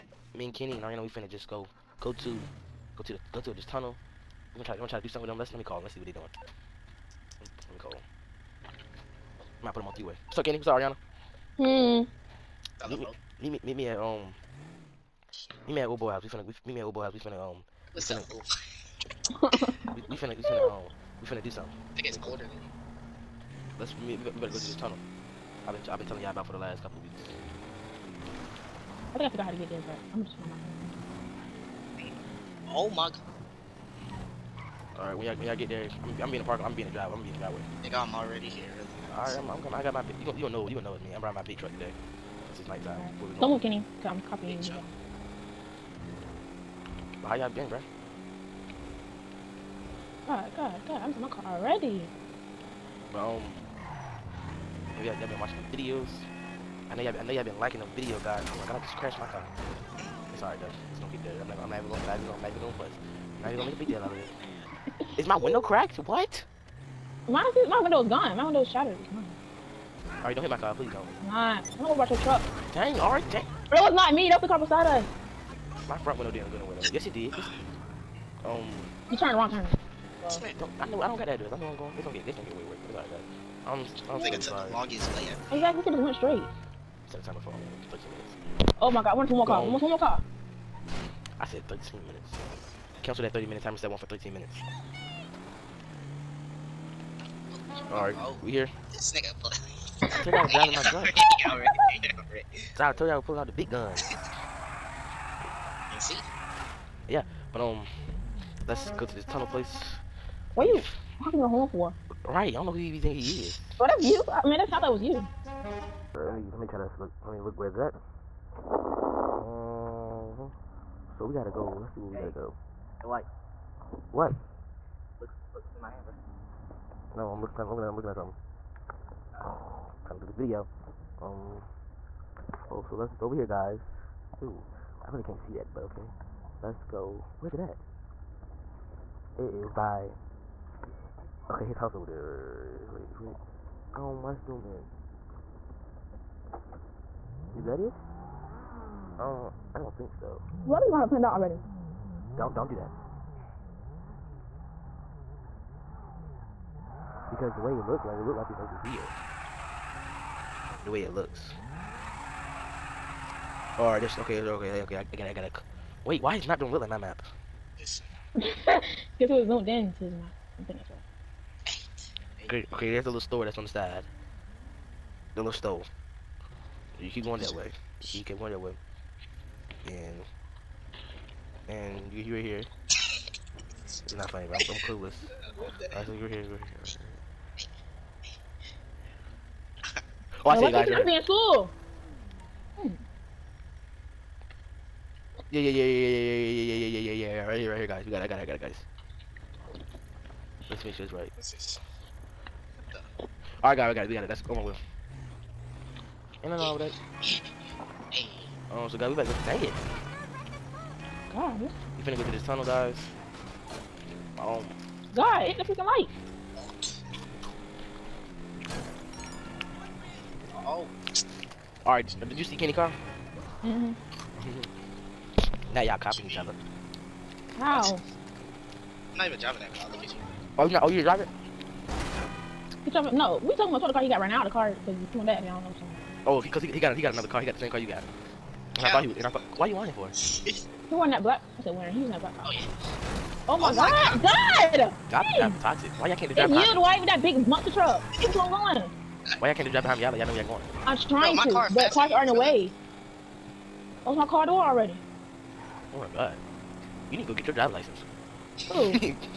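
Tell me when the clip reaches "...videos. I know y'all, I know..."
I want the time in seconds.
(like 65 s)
55 s.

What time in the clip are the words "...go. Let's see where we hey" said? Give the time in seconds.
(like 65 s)
121 s.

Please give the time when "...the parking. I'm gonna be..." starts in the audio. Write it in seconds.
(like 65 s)
36 s.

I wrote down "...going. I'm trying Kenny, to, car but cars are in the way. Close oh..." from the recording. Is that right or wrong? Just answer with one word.
wrong.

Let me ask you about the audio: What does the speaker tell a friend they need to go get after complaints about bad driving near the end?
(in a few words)
driver's license.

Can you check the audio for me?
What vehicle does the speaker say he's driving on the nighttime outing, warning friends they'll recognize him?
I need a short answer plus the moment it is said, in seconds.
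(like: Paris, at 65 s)
big truck, at 41 s.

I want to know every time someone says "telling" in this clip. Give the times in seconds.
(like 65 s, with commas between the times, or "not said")
26 s.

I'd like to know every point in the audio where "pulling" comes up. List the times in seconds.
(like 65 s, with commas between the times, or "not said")
103 s.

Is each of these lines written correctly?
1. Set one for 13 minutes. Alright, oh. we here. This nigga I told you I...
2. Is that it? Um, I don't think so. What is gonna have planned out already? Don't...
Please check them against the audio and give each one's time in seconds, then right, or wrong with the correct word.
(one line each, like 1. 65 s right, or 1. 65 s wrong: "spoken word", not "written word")
1. 93 s right
2. 147 s right.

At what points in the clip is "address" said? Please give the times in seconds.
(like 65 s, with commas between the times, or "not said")
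81 s.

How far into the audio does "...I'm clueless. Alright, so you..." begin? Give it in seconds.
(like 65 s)
184 s.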